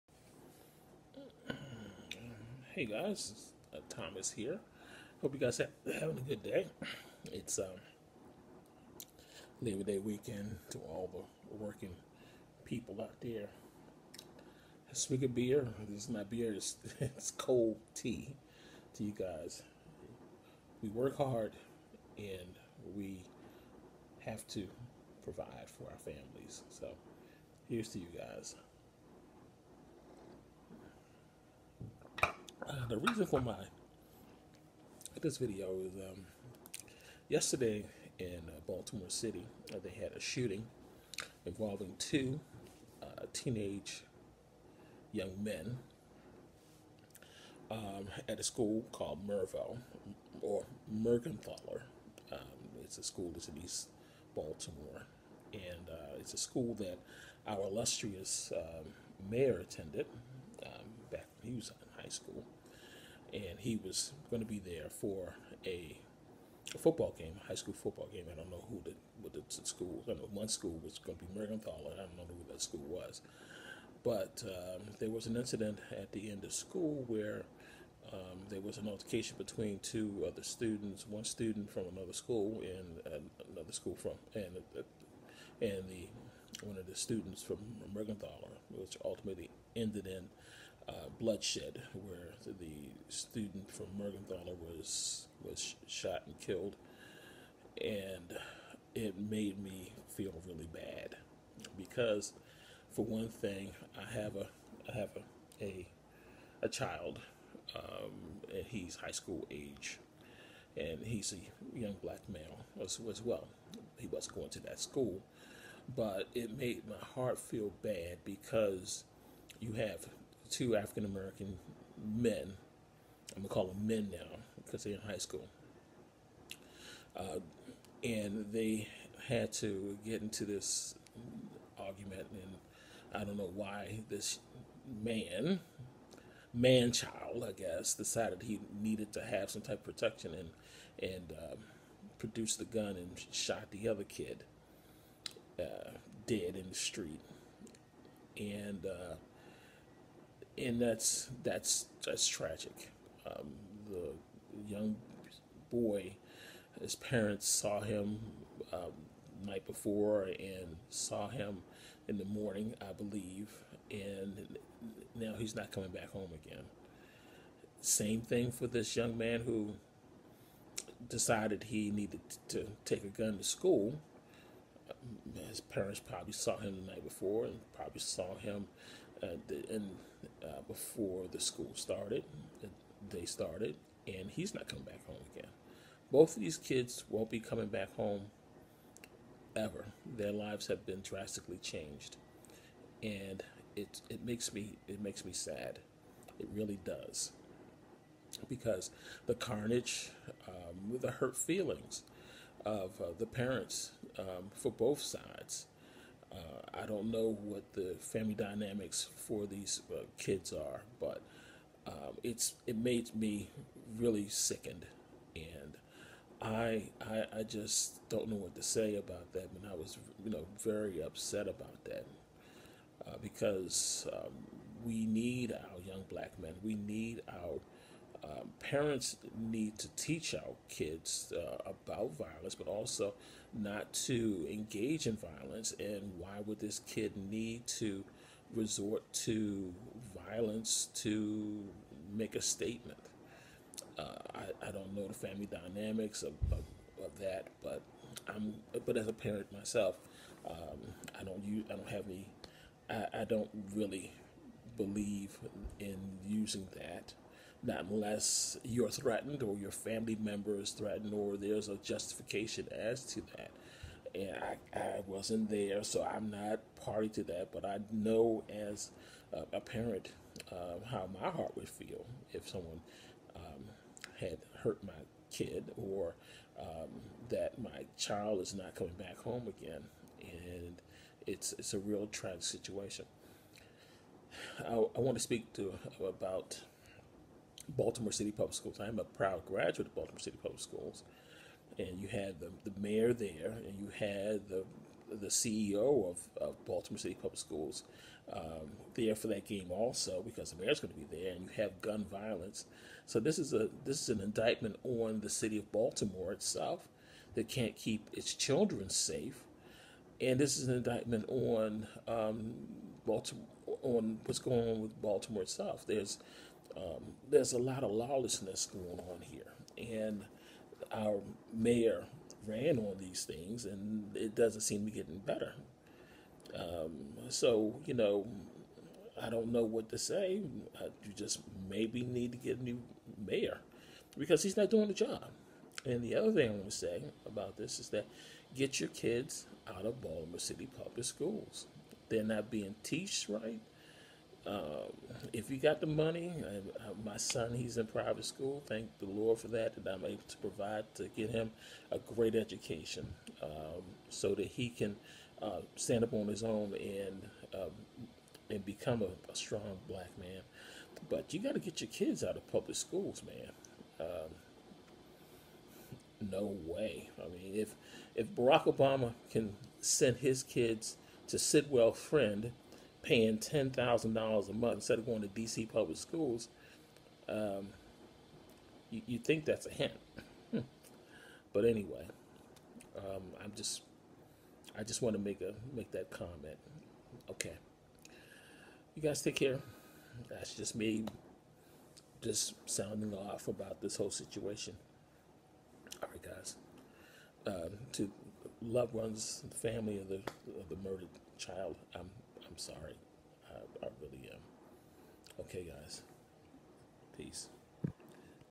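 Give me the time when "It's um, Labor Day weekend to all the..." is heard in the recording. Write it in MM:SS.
00:07.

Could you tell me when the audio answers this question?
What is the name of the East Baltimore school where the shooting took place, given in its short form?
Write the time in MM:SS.
00:49.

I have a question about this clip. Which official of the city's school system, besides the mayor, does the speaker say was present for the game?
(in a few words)
The CEO.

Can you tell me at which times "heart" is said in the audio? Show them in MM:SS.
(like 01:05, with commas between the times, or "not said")
01:57, 04:31.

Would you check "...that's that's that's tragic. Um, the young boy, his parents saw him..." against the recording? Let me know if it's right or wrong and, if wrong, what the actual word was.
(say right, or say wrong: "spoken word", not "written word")
right.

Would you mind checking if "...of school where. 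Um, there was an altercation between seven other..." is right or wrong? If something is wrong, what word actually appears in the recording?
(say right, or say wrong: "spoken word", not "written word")
wrong: "two", not "seven".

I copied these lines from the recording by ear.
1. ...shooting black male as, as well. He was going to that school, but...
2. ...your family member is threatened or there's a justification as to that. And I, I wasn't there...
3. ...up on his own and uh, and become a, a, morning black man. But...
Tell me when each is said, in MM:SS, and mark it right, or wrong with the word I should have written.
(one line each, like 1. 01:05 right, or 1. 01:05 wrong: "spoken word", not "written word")
1. 01:51 wrong: "young", not "shooting"
2. 04:19 right
3. 05:56 wrong: "strong", not "morning".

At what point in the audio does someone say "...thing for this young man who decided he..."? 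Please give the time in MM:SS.
02:48.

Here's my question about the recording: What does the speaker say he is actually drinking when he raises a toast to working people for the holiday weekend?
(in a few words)
Cold tea.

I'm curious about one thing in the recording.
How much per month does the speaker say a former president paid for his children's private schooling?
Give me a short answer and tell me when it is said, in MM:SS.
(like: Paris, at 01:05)
$10,000, at 06:13.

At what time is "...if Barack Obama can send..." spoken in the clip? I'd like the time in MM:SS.
06:08.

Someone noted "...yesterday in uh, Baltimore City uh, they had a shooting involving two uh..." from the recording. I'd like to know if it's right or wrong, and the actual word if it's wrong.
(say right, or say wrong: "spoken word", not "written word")
right.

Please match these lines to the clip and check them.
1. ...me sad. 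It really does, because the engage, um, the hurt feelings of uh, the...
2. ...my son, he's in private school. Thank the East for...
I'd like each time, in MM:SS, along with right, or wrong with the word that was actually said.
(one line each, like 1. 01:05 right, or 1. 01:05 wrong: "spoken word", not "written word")
1. 03:15 wrong: "carnage", not "engage"
2. 05:47 wrong: "Lord", not "East".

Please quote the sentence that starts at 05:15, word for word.
There's um, there's a lot of lawlessness going on here.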